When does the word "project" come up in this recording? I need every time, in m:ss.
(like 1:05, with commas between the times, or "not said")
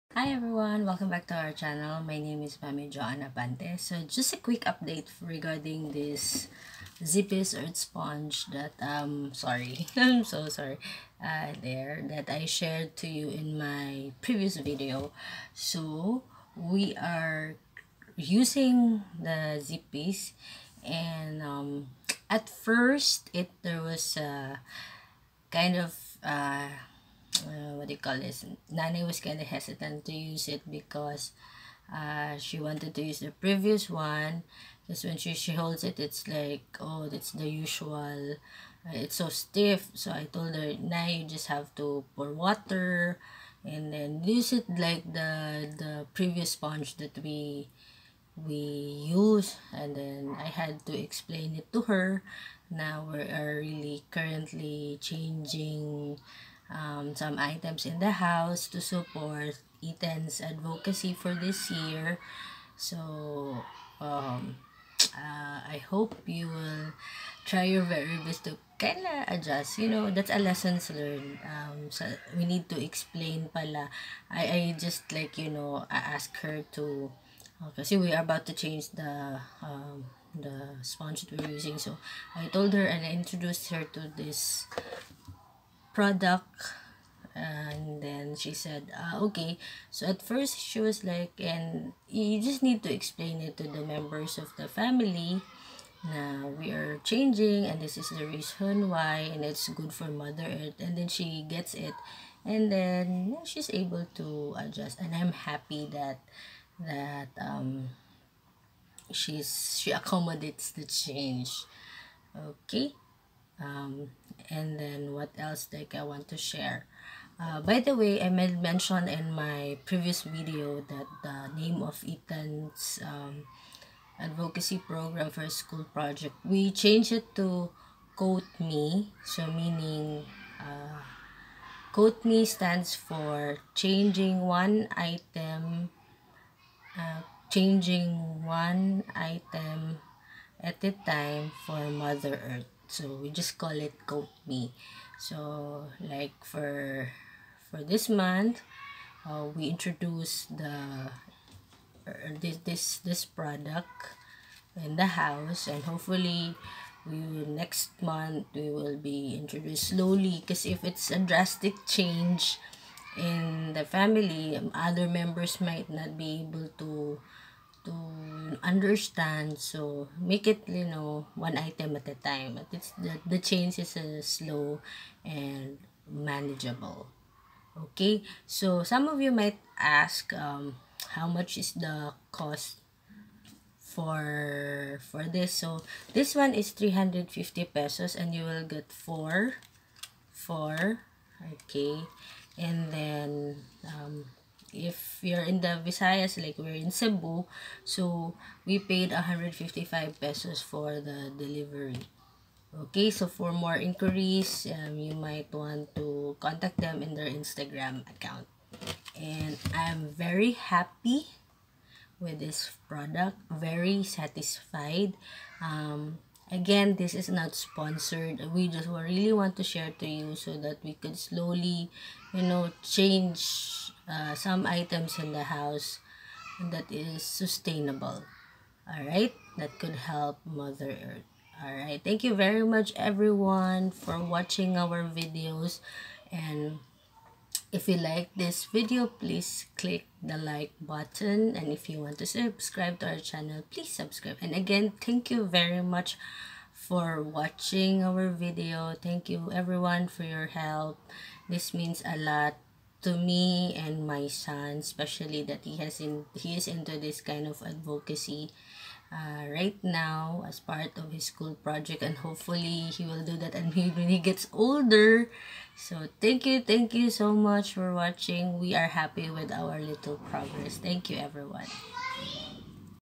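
2:05, 4:21.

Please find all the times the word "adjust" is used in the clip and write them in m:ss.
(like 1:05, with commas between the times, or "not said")
1:09, 1:44.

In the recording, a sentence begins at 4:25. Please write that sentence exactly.
So thank you, thank you so much for watching.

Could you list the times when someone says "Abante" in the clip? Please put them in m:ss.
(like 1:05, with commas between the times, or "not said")
0:03.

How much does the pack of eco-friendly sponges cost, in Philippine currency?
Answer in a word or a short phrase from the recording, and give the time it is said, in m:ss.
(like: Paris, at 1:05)
350 pesos, at 3:06.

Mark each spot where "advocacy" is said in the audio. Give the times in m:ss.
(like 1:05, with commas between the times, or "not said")
1:00, 2:04, 4:17.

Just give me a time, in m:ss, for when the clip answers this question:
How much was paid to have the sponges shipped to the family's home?
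3:19.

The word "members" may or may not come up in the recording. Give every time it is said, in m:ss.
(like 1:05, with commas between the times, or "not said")
1:33, 2:45.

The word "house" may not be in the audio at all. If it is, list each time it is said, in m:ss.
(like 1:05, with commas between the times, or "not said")
0:58, 2:35, 3:45.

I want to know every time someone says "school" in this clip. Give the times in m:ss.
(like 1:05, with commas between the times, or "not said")
2:05, 4:21.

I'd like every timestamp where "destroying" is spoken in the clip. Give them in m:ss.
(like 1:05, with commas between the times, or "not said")
not said.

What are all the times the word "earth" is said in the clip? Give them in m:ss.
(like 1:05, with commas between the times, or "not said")
0:07, 1:40, 2:22, 3:50.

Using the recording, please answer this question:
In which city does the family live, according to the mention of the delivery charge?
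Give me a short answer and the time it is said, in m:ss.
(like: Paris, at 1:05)
Cebu, at 3:16.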